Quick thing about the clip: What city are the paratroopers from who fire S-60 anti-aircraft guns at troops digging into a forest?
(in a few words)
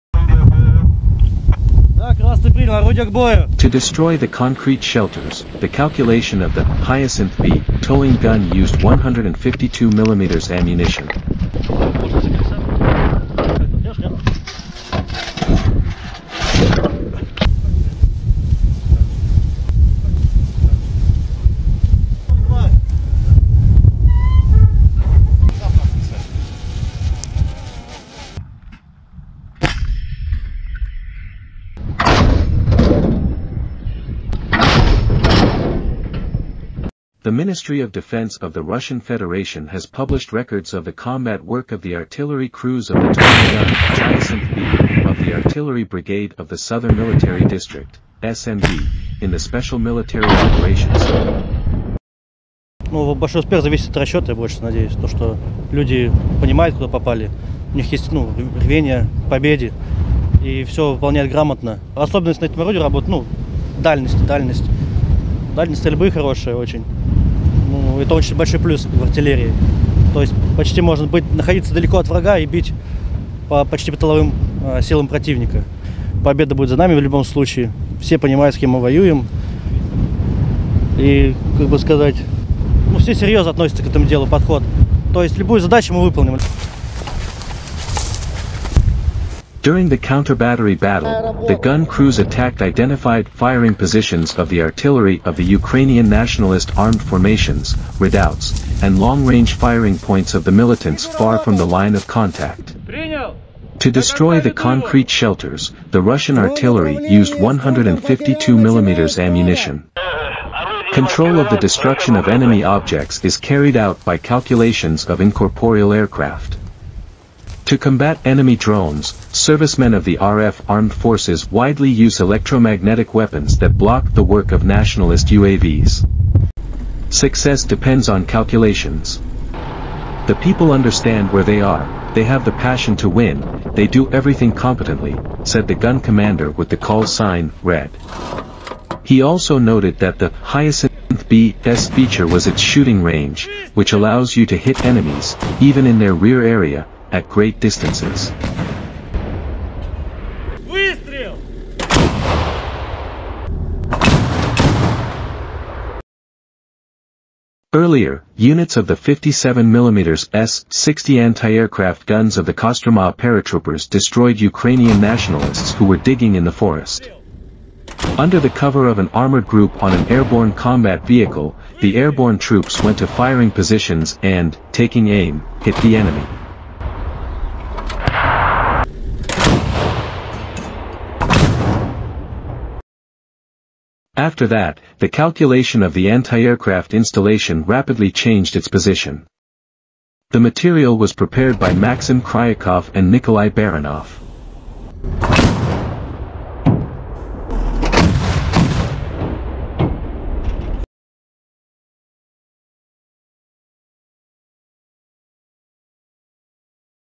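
Kostroma.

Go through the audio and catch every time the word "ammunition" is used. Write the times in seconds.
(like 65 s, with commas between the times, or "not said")
10 s, 109 s.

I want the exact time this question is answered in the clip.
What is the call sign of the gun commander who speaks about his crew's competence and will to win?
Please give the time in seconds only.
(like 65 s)
137 s.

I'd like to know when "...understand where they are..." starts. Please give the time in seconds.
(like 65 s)
130 s.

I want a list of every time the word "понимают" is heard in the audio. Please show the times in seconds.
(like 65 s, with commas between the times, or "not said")
56 s, 78 s.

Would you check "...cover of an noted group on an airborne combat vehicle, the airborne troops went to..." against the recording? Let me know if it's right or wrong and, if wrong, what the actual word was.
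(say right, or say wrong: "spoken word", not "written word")
wrong: "armored", not "noted".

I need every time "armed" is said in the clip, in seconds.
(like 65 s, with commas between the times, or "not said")
96 s, 120 s.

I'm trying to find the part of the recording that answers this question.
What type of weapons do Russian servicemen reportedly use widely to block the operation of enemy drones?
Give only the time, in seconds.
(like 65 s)
122 s.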